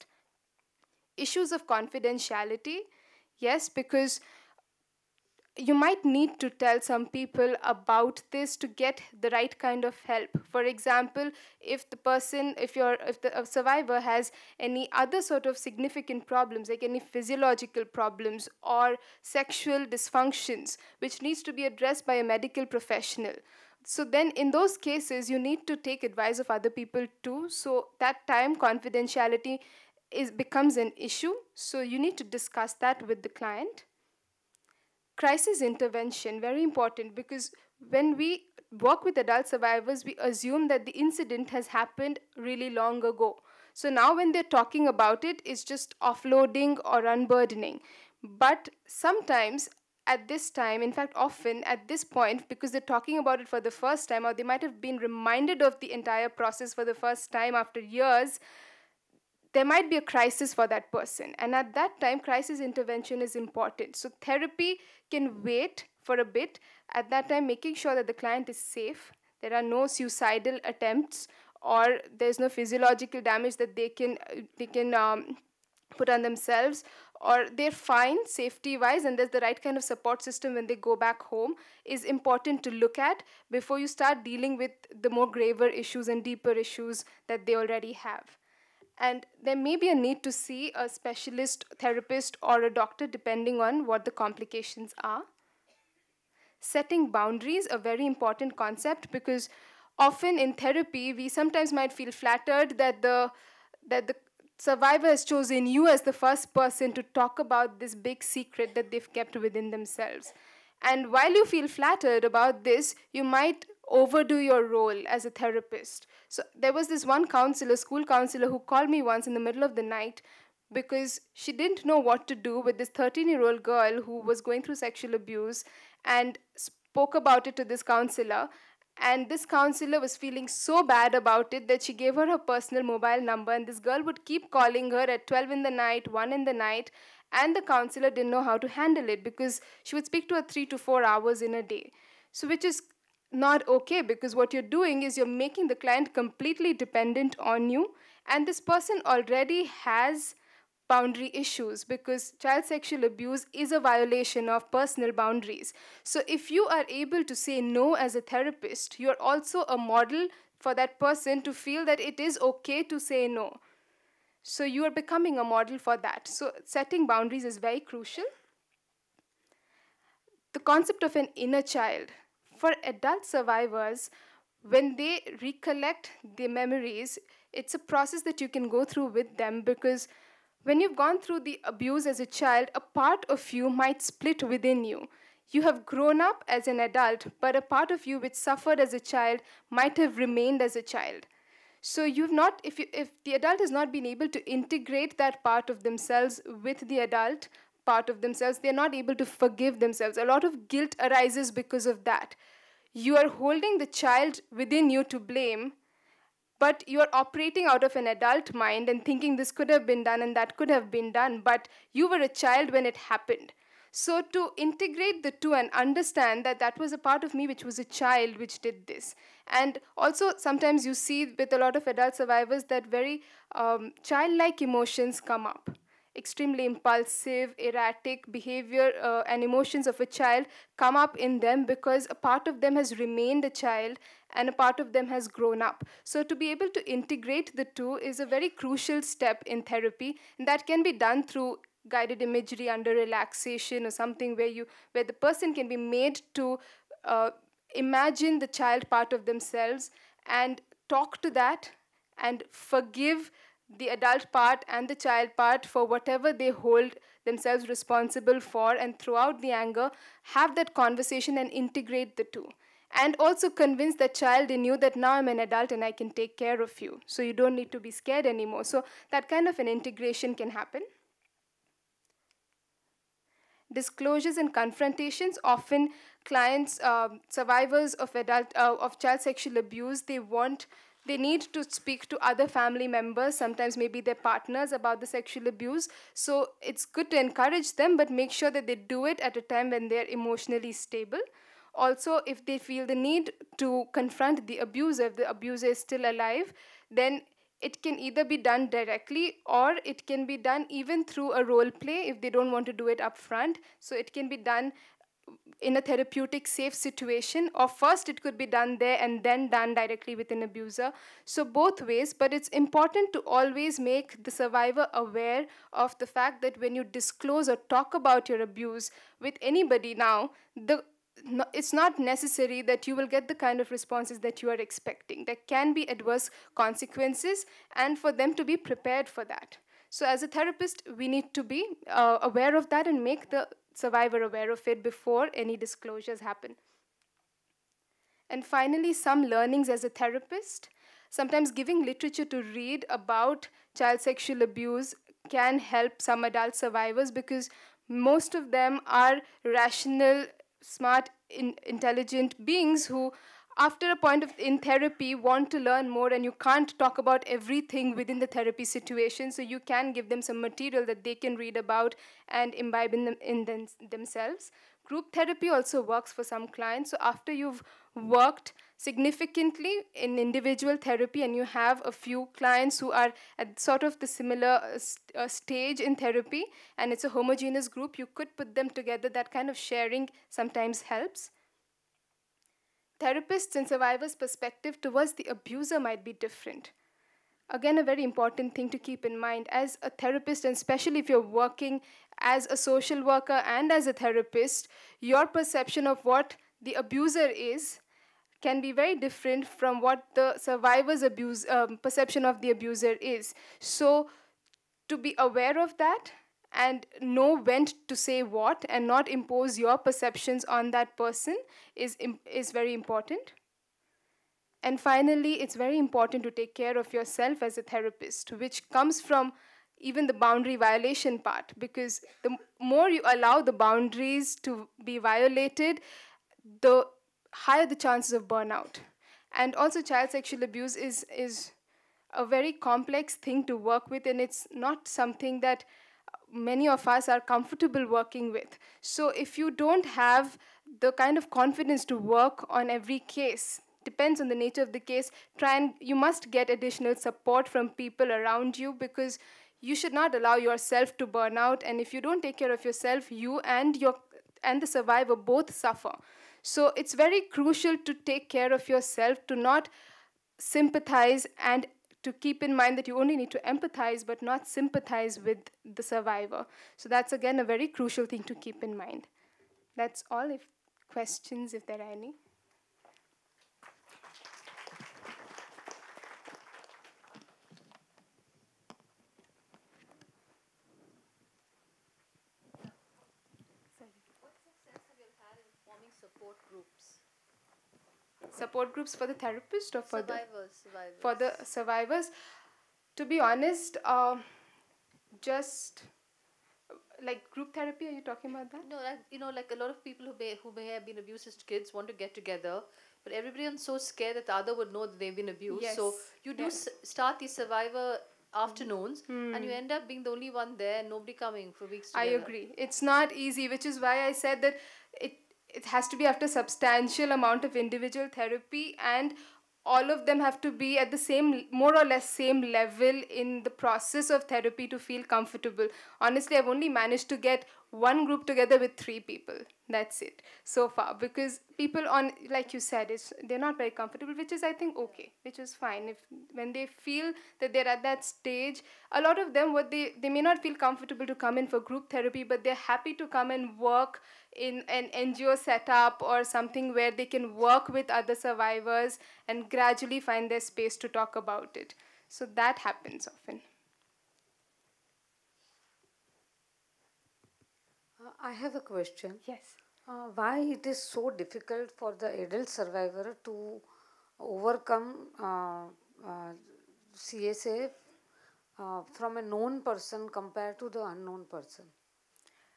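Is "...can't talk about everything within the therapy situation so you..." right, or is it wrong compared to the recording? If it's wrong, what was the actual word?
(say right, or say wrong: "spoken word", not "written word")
right.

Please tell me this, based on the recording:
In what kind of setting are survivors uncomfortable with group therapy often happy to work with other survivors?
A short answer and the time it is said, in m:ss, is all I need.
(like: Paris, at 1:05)
NGO setup, at 9:04.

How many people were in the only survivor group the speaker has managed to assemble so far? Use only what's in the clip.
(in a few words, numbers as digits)
3.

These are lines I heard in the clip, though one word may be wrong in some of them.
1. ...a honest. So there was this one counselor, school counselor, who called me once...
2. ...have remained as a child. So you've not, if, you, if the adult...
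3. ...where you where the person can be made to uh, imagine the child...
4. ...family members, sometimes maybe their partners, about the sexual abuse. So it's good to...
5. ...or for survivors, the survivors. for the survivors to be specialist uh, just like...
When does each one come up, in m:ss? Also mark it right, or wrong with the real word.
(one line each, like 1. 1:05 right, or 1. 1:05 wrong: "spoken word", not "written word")
1. 1:55 wrong: "therapist", not "honest"
2. 3:09 right
3. 4:04 right
4. 4:42 right
5. 8:09 wrong: "honest", not "specialist".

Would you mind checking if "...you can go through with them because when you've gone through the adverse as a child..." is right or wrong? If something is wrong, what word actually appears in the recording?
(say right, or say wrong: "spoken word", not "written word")
wrong: "abuse", not "adverse".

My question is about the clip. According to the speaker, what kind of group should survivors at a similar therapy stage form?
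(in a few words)
homogeneous group.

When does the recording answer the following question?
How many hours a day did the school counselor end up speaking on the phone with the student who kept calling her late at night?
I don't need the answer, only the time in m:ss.
2:20.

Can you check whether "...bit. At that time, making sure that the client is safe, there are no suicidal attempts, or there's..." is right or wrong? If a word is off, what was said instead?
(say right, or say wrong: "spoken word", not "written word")
right.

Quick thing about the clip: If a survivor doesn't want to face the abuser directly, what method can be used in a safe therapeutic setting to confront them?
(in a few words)
role play.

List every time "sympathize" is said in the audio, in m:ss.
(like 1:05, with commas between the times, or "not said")
7:40, 7:44.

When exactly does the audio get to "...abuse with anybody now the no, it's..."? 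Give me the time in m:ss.
5:18.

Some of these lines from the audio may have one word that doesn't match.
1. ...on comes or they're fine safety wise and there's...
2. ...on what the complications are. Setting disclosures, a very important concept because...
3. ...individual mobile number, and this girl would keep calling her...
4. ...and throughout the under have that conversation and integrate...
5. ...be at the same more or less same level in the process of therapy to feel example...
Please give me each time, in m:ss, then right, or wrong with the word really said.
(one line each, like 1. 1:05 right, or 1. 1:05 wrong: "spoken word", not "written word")
1. 1:16 wrong: "themselves", not "comes"
2. 1:33 wrong: "boundaries", not "disclosures"
3. 2:12 wrong: "personal", not "individual"
4. 4:18 wrong: "anger", not "under"
5. 8:40 wrong: "comfortable", not "example".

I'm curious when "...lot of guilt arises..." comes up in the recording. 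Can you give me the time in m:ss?
3:20.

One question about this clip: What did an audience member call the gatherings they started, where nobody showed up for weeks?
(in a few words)
survivor afternoons.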